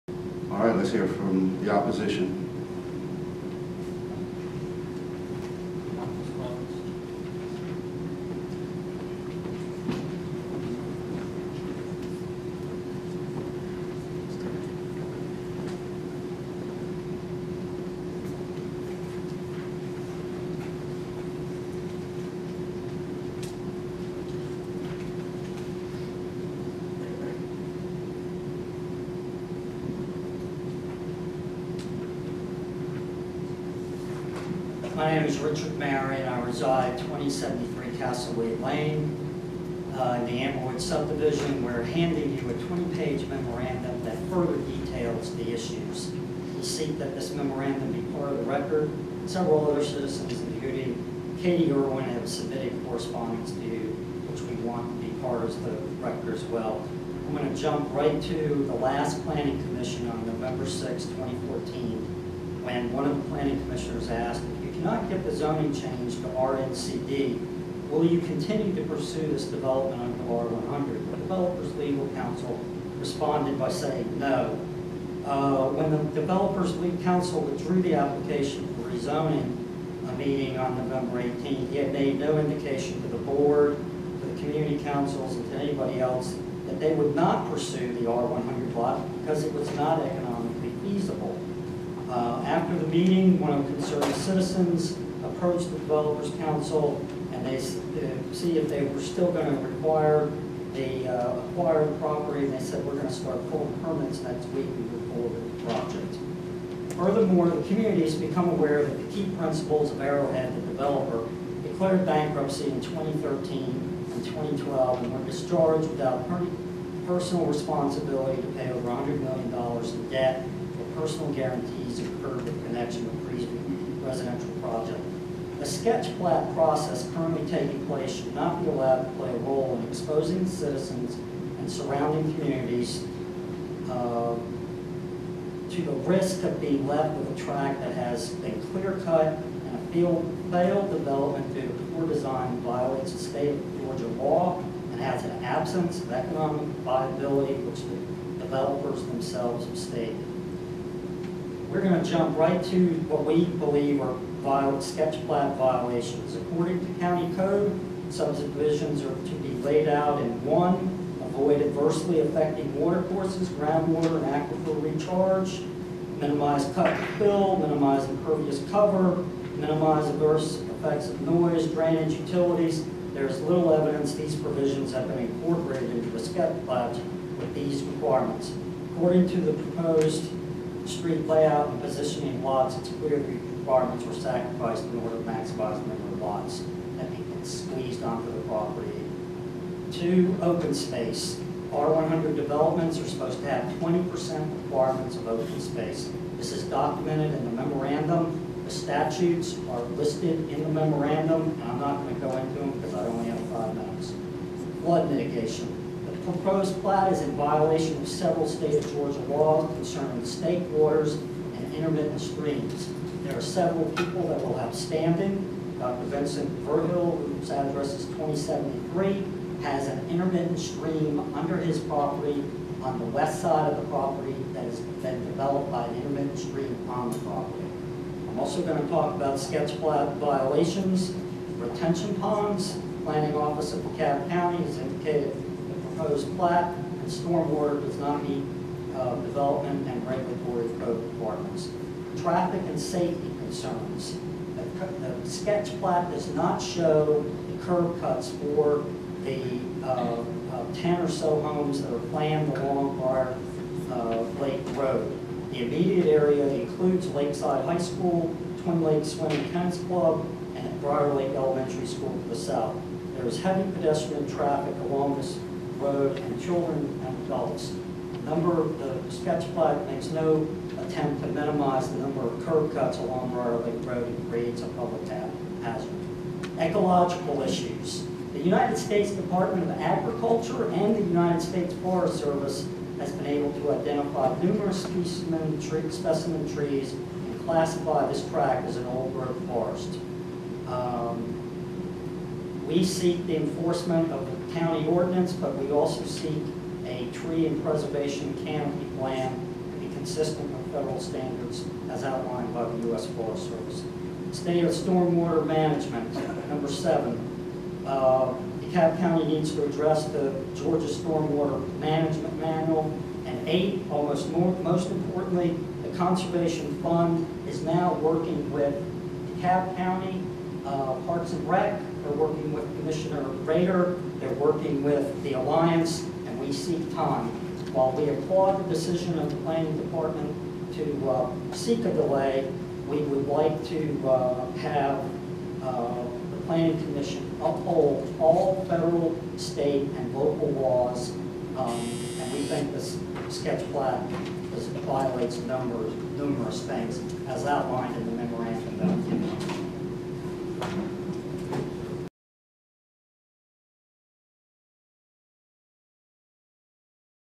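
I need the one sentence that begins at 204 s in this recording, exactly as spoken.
Flood mitigation proposed plat is in violation of several state of Georgia laws concerning state waters and intermittent streams.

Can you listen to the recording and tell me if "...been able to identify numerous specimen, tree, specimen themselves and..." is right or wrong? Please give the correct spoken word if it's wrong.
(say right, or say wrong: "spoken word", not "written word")
wrong: "trees", not "themselves".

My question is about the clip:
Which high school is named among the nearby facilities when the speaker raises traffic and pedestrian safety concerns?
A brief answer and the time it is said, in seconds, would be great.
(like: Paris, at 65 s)
Lakeside High School, at 257 s.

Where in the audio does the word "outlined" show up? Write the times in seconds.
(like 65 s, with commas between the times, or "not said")
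302 s, 347 s.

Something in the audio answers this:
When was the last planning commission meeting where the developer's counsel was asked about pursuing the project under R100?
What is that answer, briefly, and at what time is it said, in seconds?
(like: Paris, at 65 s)
November 6, 2014, at 60 s.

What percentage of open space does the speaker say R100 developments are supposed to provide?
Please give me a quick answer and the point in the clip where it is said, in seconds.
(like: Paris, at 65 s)
20%, at 193 s.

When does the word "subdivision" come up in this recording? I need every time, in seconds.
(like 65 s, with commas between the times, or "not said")
40 s, 158 s.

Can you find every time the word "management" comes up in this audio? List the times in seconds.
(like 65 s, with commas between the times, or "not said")
305 s, 311 s.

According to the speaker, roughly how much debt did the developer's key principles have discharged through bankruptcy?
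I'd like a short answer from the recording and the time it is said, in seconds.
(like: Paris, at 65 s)
Over $100 million, at 118 s.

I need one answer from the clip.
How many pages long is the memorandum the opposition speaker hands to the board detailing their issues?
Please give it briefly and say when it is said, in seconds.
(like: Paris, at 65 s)
20, at 42 s.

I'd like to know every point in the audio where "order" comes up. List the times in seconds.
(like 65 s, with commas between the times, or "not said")
185 s.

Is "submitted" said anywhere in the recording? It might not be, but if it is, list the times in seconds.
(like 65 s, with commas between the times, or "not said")
52 s.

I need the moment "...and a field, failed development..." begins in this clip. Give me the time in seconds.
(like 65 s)
139 s.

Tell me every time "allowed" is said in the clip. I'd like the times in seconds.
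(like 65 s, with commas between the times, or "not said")
128 s.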